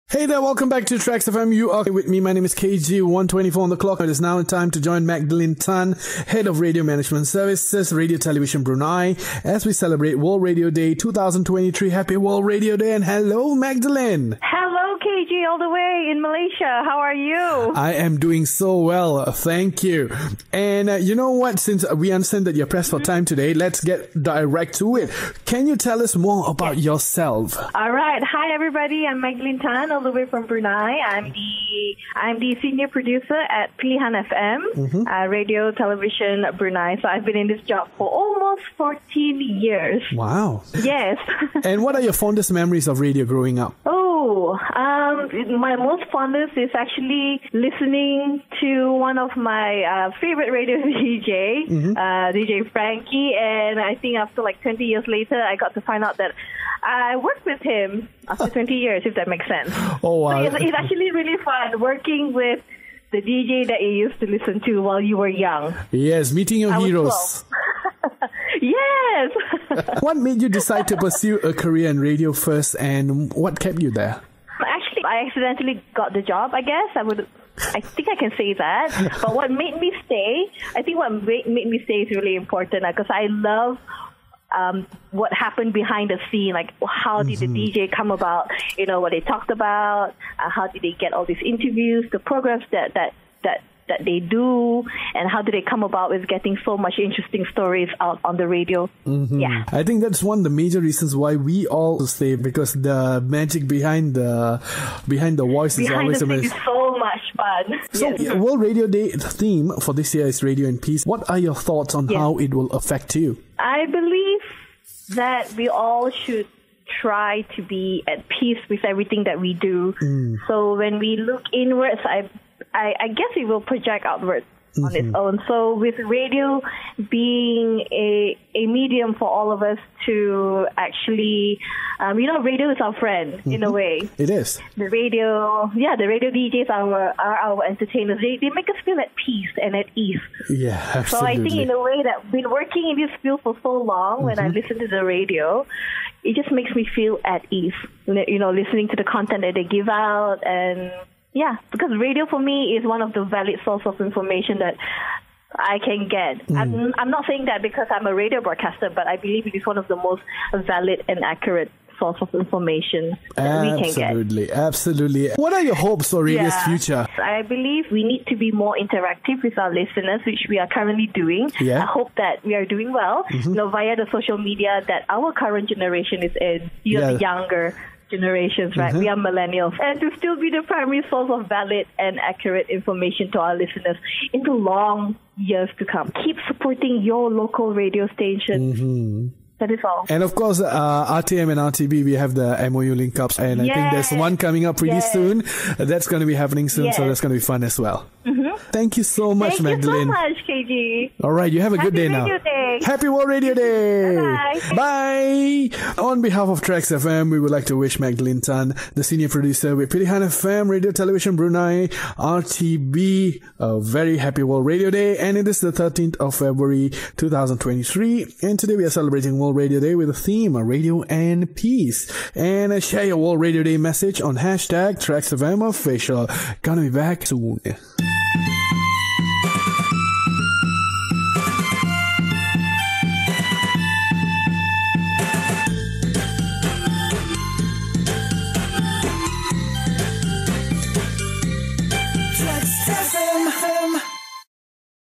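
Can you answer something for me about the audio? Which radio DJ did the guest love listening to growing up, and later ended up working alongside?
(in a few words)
DJ Frankie.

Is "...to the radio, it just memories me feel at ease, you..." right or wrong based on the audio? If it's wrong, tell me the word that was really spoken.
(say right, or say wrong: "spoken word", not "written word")
wrong: "makes", not "memories".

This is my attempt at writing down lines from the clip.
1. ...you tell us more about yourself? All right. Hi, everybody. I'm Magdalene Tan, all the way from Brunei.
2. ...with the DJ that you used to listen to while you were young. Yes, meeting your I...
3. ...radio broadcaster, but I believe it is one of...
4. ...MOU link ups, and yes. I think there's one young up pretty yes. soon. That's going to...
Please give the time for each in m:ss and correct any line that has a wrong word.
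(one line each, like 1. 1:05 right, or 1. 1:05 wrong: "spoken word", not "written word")
1. 0:25 right
2. 1:02 right
3. 2:38 right
4. 3:12 wrong: "coming", not "young".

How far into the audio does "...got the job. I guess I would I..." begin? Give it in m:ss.
1:15.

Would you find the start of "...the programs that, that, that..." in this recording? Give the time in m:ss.
1:32.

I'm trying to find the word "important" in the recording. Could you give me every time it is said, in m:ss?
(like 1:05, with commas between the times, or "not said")
1:22.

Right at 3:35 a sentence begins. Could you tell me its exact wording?
And it is the 13th of February 2023.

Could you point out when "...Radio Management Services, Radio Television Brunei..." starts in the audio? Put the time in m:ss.
0:06.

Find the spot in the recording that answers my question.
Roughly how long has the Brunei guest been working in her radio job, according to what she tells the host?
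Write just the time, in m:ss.
0:38.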